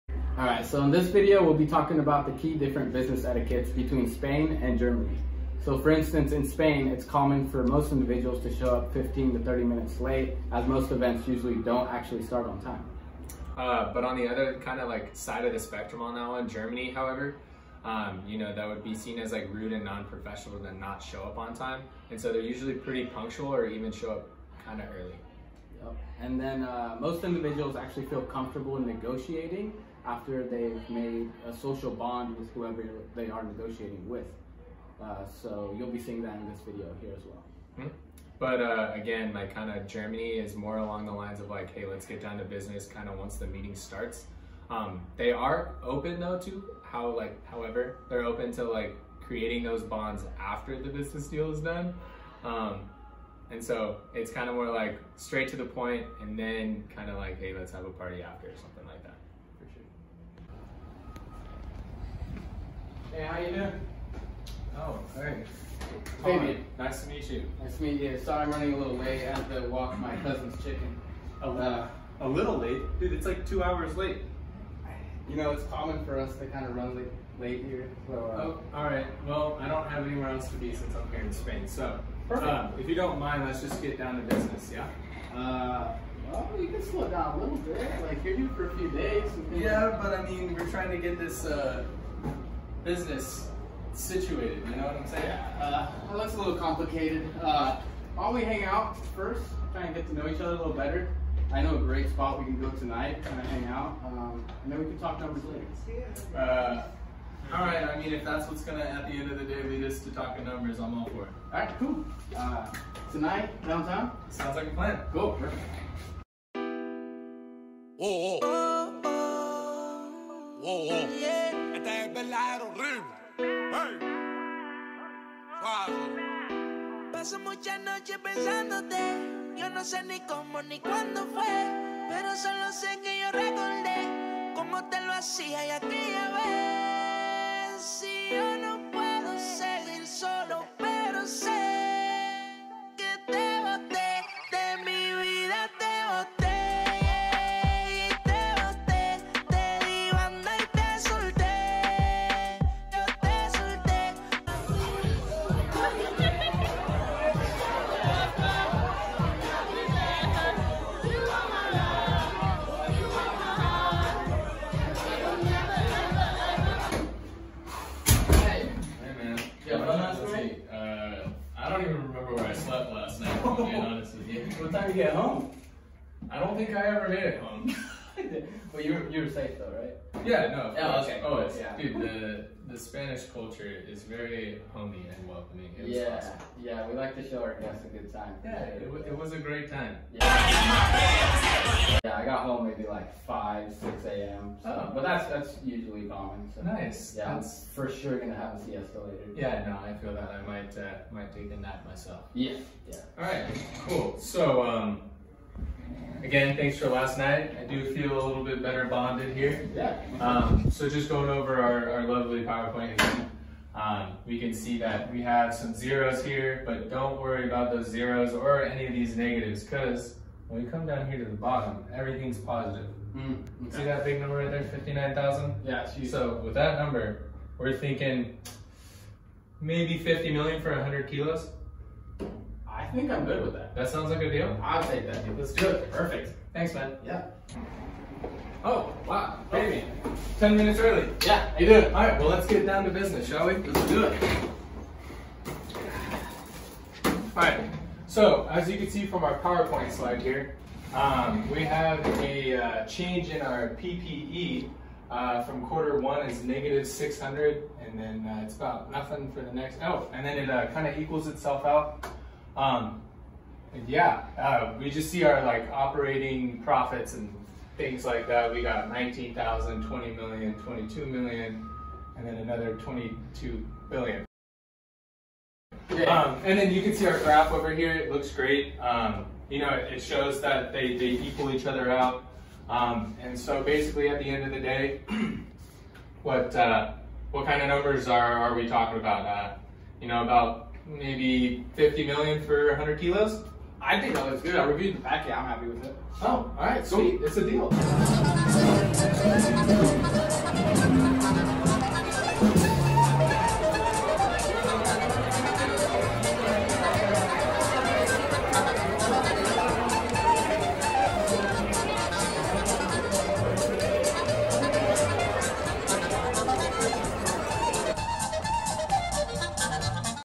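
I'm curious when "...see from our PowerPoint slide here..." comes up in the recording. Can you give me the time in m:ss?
4:08.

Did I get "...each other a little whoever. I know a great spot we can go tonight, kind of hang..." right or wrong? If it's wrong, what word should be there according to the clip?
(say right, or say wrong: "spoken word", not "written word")
wrong: "better", not "whoever".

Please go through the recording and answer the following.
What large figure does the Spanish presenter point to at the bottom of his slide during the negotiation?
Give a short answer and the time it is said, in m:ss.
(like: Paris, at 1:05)
59,000, at 3:44.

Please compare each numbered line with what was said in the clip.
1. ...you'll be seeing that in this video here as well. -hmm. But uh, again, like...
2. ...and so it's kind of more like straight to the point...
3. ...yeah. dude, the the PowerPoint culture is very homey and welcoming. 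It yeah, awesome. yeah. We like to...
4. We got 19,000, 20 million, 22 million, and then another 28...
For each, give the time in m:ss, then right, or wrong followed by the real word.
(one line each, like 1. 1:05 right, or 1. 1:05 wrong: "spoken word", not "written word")
1. 0:35 right
2. 0:53 right
3. 3:01 wrong: "Spanish", not "PowerPoint"
4. 4:28 wrong: "22", not "28".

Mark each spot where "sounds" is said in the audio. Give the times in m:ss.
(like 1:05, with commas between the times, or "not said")
1:54, 3:53.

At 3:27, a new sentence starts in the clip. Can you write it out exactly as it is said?
I do feel a little bit better bonded here.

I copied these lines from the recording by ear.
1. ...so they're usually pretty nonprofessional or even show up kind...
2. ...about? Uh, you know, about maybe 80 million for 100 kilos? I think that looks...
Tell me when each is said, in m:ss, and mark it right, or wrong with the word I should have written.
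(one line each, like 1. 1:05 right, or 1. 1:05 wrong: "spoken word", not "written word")
1. 0:22 wrong: "punctual", not "nonprofessional"
2. 4:48 wrong: "50", not "80".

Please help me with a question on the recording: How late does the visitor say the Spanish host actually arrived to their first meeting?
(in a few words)
2 hours.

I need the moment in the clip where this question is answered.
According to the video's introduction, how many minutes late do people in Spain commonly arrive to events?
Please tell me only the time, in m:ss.
0:08.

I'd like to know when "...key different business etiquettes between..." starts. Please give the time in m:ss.
0:02.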